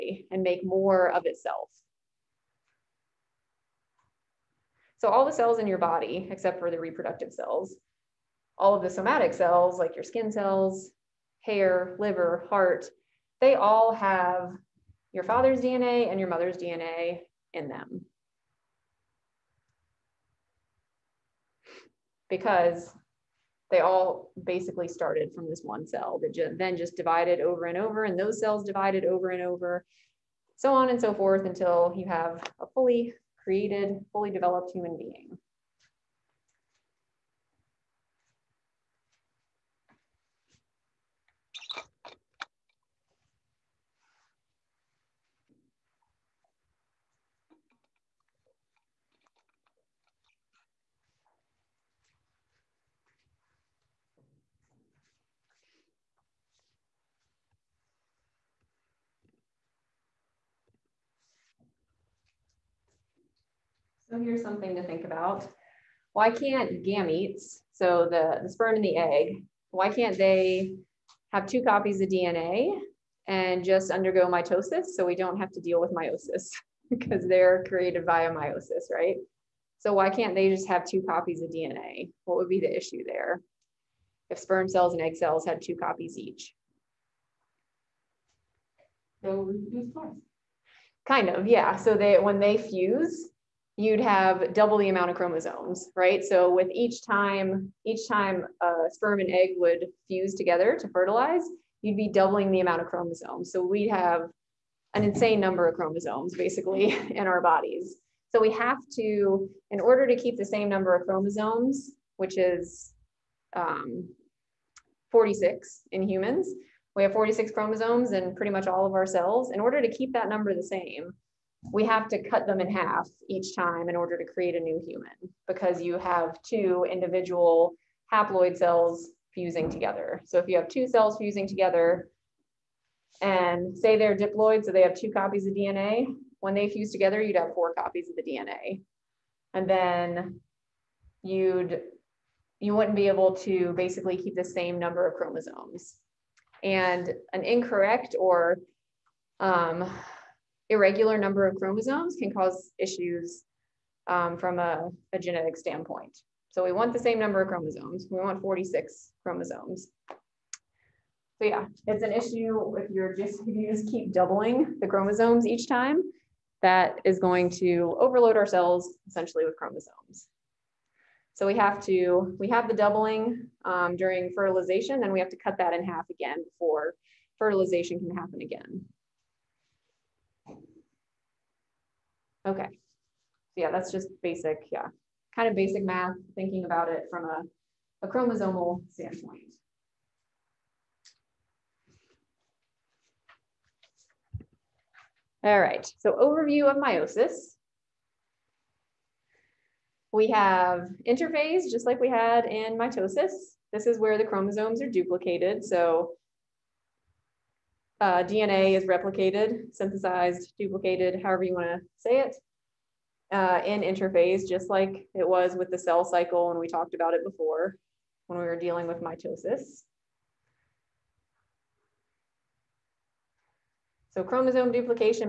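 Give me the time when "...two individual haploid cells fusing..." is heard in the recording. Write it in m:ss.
2:06.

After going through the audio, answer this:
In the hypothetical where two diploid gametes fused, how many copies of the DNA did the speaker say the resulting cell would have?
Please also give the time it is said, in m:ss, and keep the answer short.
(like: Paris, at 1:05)
4 copies, at 2:17.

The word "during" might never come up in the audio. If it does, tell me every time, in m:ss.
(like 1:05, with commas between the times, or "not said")
2:53.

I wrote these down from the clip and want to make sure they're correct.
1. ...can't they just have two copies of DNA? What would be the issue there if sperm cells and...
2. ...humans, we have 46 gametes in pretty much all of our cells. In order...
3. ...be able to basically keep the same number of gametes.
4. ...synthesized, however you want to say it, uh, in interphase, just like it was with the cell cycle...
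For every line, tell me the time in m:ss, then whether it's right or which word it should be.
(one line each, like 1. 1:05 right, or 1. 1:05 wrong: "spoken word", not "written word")
1. 1:20 right
2. 1:56 wrong: "chromosomes", not "gametes"
3. 2:22 wrong: "chromosomes", not "gametes"
4. 3:30 wrong: "duplicated", not "synthesized".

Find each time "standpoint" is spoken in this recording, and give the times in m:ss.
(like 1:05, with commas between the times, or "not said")
2:35, 3:08.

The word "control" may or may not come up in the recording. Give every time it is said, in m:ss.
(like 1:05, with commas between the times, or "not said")
not said.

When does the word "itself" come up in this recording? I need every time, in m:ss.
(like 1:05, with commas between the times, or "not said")
0:01.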